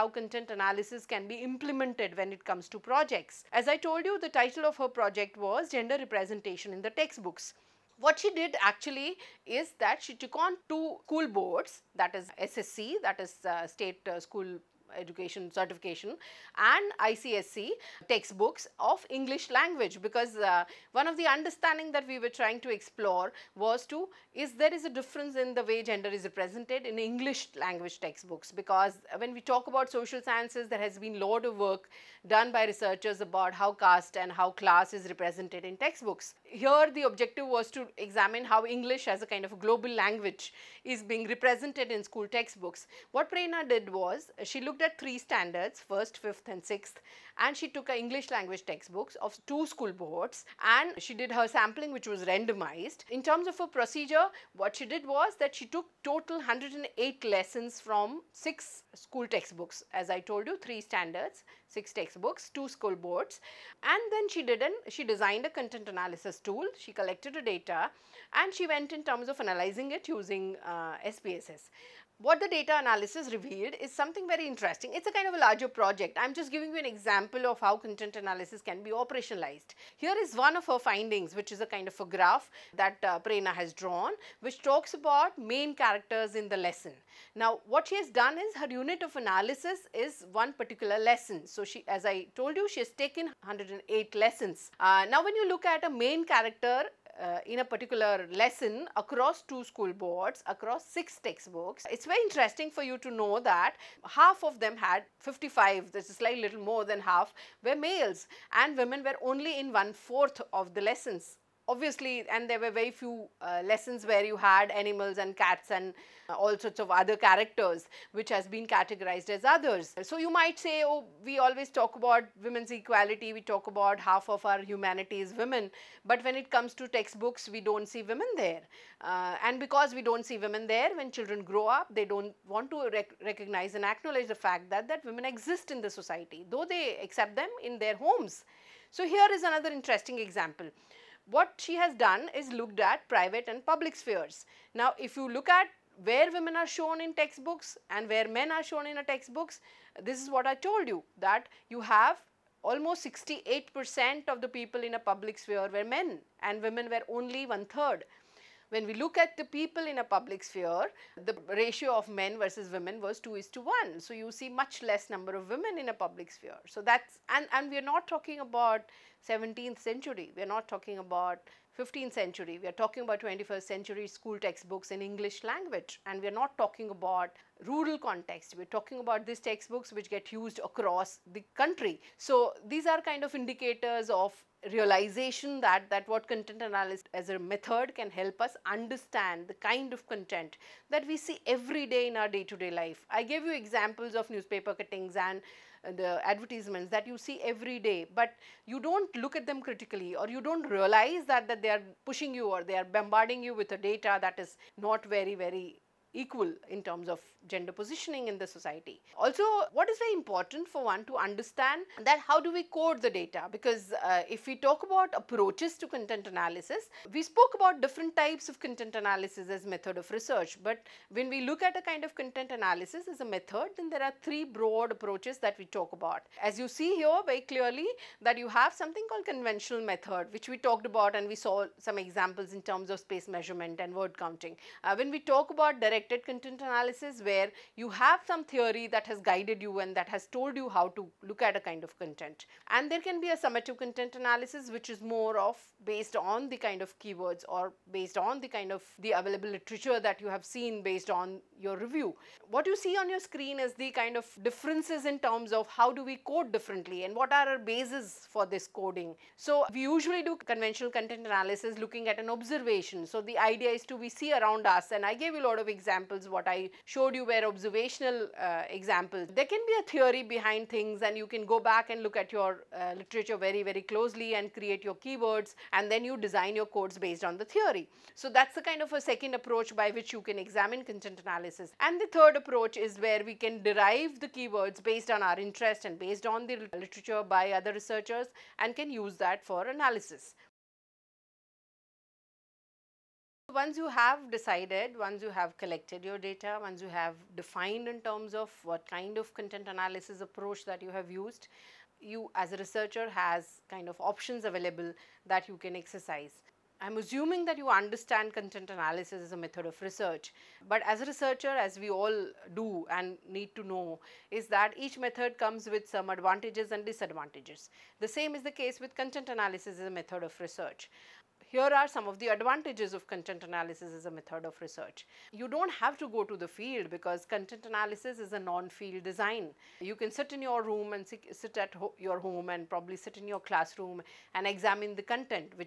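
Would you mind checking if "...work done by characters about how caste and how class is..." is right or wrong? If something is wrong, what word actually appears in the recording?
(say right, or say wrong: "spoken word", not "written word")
wrong: "researchers", not "characters".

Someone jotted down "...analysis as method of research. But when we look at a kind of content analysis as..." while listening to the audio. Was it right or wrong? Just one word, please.
right.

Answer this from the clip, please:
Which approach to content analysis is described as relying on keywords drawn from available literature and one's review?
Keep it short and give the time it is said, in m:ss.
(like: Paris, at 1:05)
Summative content analysis, at 4:03.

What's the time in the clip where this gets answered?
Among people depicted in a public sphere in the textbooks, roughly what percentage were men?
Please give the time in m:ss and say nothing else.
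2:33.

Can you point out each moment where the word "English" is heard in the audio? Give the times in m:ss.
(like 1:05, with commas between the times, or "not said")
0:19, 0:26, 0:38, 0:47, 2:55.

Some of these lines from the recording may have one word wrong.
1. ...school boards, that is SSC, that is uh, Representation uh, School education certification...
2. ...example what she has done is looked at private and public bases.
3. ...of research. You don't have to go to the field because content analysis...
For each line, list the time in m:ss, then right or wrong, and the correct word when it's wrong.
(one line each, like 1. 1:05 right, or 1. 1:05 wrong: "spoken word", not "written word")
1. 0:11 wrong: "State", not "Representation"
2. 2:20 wrong: "spheres", not "bases"
3. 5:24 right.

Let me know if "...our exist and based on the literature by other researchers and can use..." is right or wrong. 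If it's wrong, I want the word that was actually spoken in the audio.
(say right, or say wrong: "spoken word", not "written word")
wrong: "interest", not "exist".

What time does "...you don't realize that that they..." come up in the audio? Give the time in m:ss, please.
3:20.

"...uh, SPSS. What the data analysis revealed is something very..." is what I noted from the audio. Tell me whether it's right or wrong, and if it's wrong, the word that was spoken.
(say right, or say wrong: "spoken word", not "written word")
right.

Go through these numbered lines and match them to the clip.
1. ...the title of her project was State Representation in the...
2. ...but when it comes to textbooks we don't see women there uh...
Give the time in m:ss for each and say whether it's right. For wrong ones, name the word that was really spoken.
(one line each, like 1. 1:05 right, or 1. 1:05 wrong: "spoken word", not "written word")
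1. 0:04 wrong: "Gender", not "State"
2. 2:06 right.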